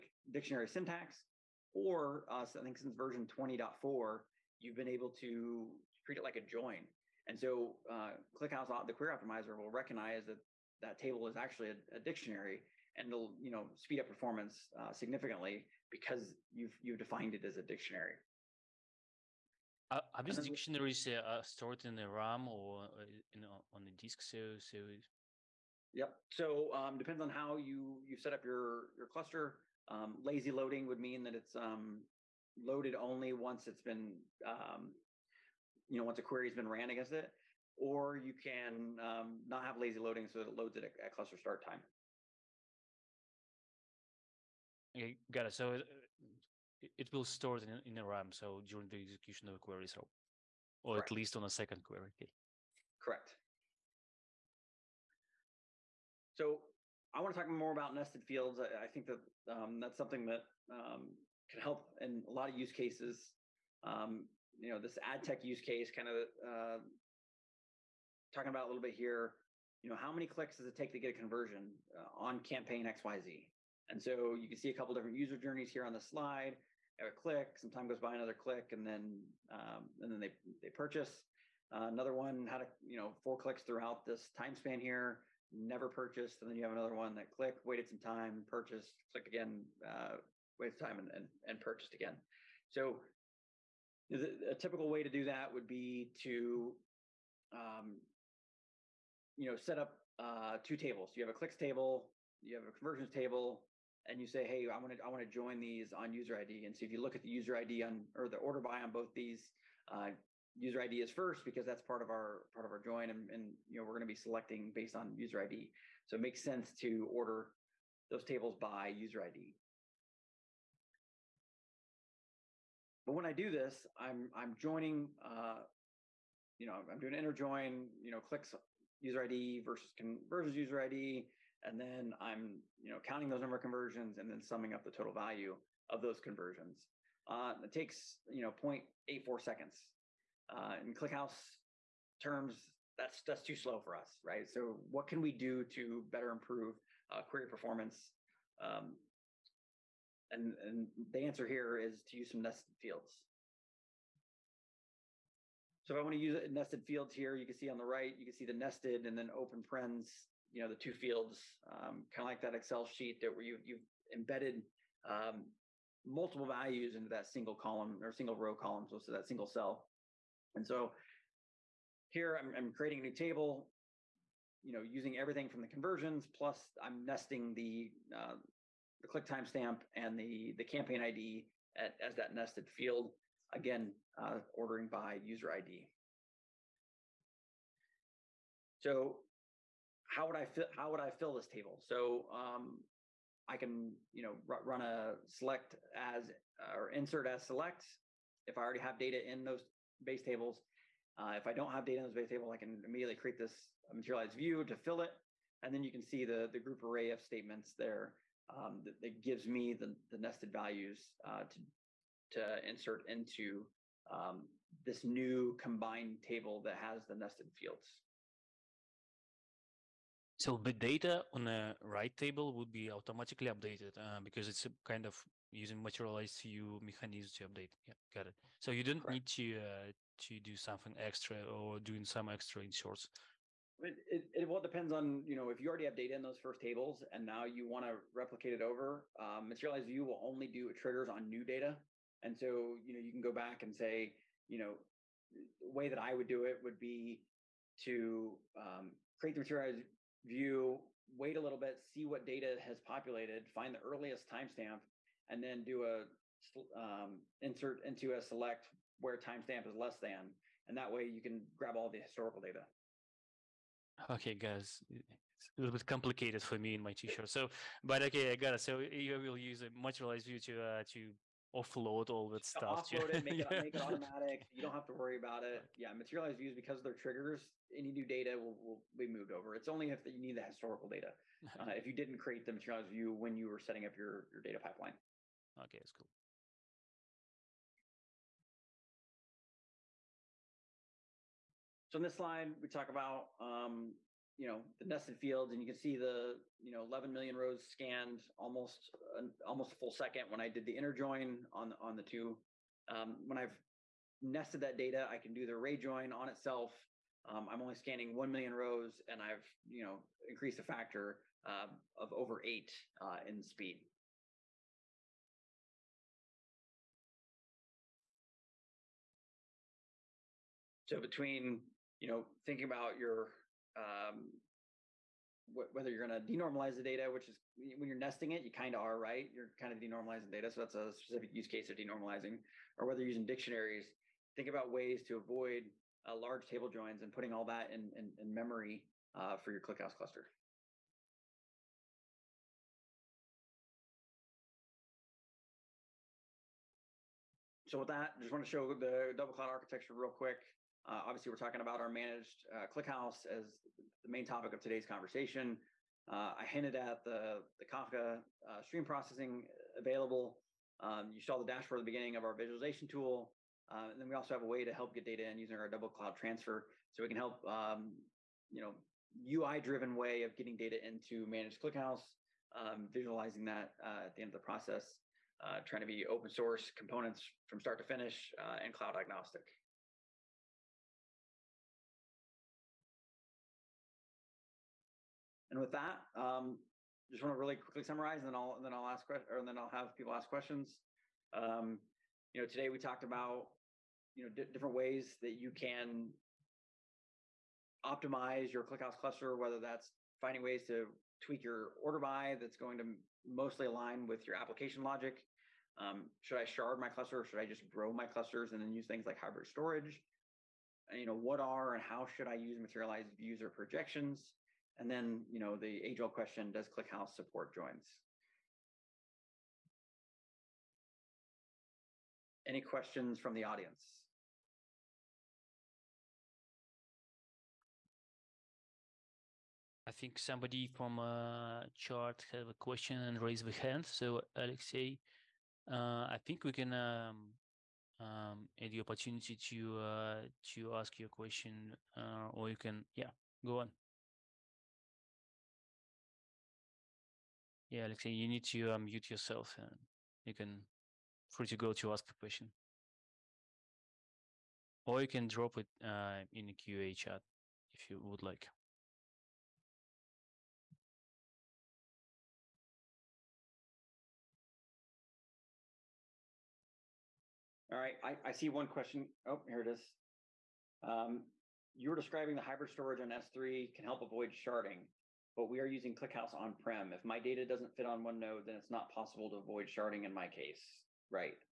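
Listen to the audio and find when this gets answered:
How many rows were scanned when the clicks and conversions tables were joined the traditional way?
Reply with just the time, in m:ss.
4:56.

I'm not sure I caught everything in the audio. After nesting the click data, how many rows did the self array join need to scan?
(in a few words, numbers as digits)
1 million.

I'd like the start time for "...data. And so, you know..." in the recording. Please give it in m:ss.
4:01.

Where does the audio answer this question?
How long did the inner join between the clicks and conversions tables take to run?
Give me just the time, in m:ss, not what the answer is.
2:18.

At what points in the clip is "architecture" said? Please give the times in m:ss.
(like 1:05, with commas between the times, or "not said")
5:49.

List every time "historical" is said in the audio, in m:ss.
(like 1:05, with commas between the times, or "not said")
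4:22, 4:40.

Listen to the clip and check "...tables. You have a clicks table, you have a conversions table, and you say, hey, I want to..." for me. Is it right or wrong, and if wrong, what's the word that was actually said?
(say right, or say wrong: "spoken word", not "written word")
right.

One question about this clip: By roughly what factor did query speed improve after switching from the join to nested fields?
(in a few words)
over 8.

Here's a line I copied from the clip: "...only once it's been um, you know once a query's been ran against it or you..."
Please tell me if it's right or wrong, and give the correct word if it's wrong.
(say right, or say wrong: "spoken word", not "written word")
right.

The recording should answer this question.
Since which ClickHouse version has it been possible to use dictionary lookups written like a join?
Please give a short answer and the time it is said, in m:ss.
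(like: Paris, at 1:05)
20.4, at 0:03.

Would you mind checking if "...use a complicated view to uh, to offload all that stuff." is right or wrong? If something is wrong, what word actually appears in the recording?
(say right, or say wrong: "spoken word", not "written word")
wrong: "materialized", not "complicated".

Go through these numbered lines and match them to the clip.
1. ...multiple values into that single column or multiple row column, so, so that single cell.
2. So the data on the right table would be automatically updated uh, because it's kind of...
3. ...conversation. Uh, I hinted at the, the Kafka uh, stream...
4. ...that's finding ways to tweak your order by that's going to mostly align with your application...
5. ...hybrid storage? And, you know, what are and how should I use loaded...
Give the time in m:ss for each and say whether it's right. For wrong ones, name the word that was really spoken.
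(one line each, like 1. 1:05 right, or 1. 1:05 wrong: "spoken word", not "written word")
1. 2:46 wrong: "single", not "multiple"
2. 3:40 right
3. 5:54 right
4. 6:39 right
5. 6:49 wrong: "materialized", not "loaded".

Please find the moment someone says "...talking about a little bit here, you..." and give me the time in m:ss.
1:08.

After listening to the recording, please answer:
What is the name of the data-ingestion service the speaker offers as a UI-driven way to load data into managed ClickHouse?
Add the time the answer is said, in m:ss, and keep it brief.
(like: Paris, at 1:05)
Double Cloud Transfer, at 6:05.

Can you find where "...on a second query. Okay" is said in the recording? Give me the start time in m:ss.
0:51.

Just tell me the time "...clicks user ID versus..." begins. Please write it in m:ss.
2:08.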